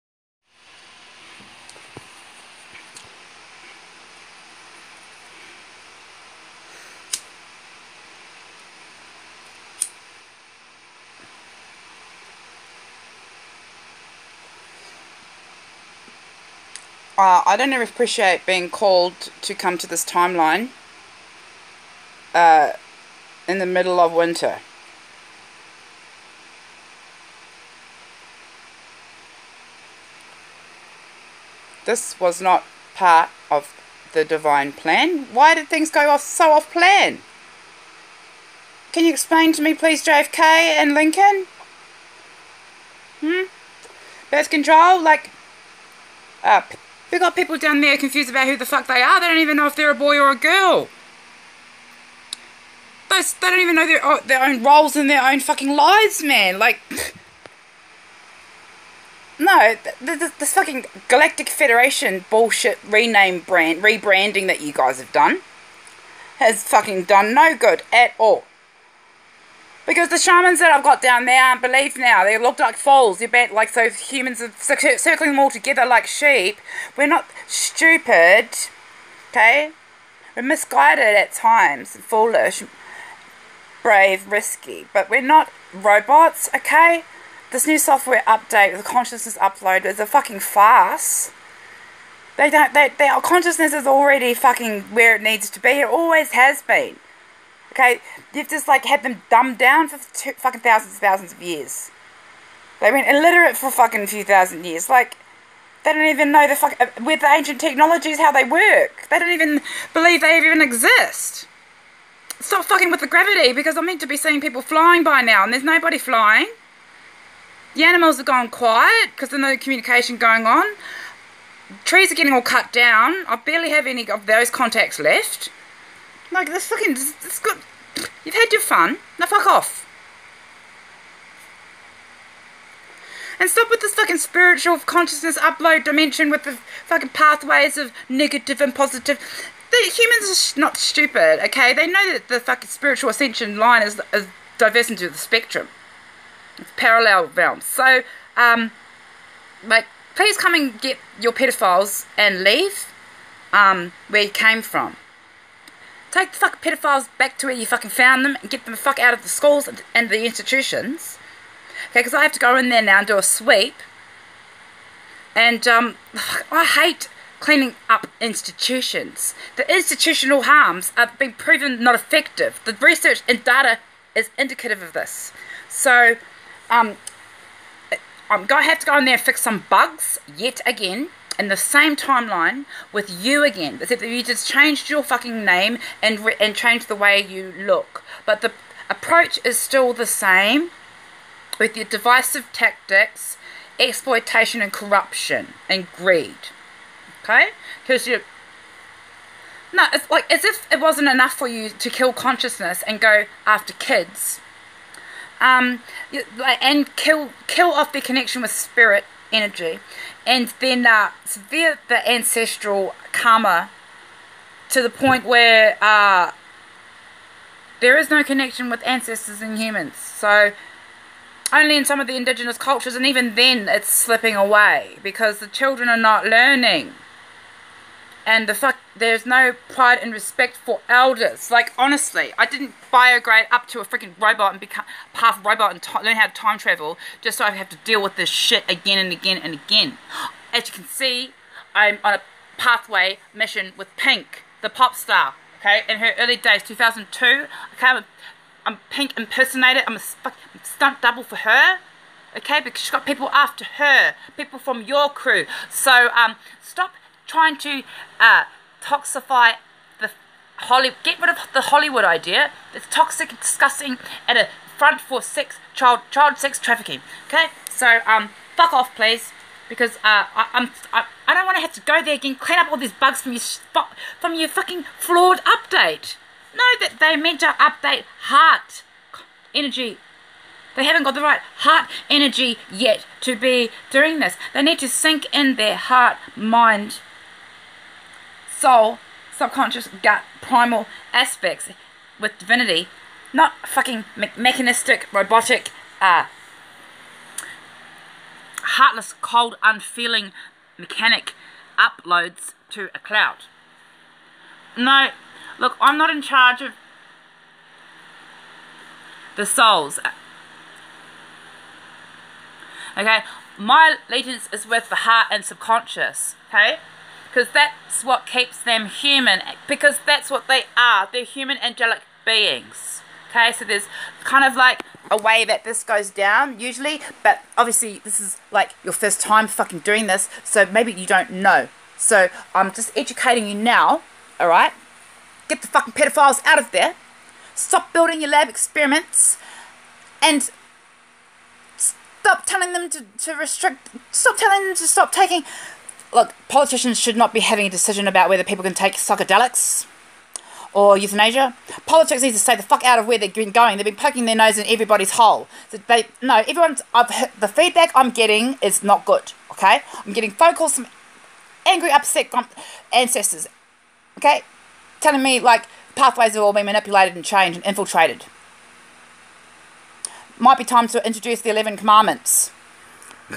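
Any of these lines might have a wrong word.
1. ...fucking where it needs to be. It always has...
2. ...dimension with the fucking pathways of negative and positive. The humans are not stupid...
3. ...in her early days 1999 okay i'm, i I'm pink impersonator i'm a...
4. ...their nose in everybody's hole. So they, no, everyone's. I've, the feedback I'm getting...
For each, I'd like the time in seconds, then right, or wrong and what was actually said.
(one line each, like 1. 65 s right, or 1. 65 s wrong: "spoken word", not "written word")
1. 94 s right
2. 135 s right
3. 245 s wrong: "2002", not "1999"
4. 354 s right.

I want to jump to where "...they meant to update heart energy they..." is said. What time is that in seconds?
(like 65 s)
276 s.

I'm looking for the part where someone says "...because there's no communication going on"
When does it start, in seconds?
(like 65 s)
119 s.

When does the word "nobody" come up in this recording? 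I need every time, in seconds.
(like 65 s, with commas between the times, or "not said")
115 s.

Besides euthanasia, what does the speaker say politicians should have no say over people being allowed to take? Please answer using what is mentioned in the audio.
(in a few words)
Psychedelics.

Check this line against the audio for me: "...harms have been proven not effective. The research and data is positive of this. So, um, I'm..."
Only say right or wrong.
wrong.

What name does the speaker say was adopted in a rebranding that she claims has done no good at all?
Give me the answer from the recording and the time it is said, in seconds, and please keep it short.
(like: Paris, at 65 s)
Galactic Federation, at 61 s.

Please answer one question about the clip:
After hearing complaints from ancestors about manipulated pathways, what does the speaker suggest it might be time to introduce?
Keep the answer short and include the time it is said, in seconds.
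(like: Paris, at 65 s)
The Eleven Commandments, at 371 s.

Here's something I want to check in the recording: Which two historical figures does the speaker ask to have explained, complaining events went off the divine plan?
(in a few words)
JFK and Lincoln.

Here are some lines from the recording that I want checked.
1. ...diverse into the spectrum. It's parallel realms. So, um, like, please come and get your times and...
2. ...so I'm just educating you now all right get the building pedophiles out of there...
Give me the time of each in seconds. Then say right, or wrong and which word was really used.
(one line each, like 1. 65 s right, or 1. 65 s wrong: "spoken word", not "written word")
1. 144 s wrong: "pedophiles", not "times"
2. 331 s wrong: "fucking", not "building".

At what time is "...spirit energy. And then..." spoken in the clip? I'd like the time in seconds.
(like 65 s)
208 s.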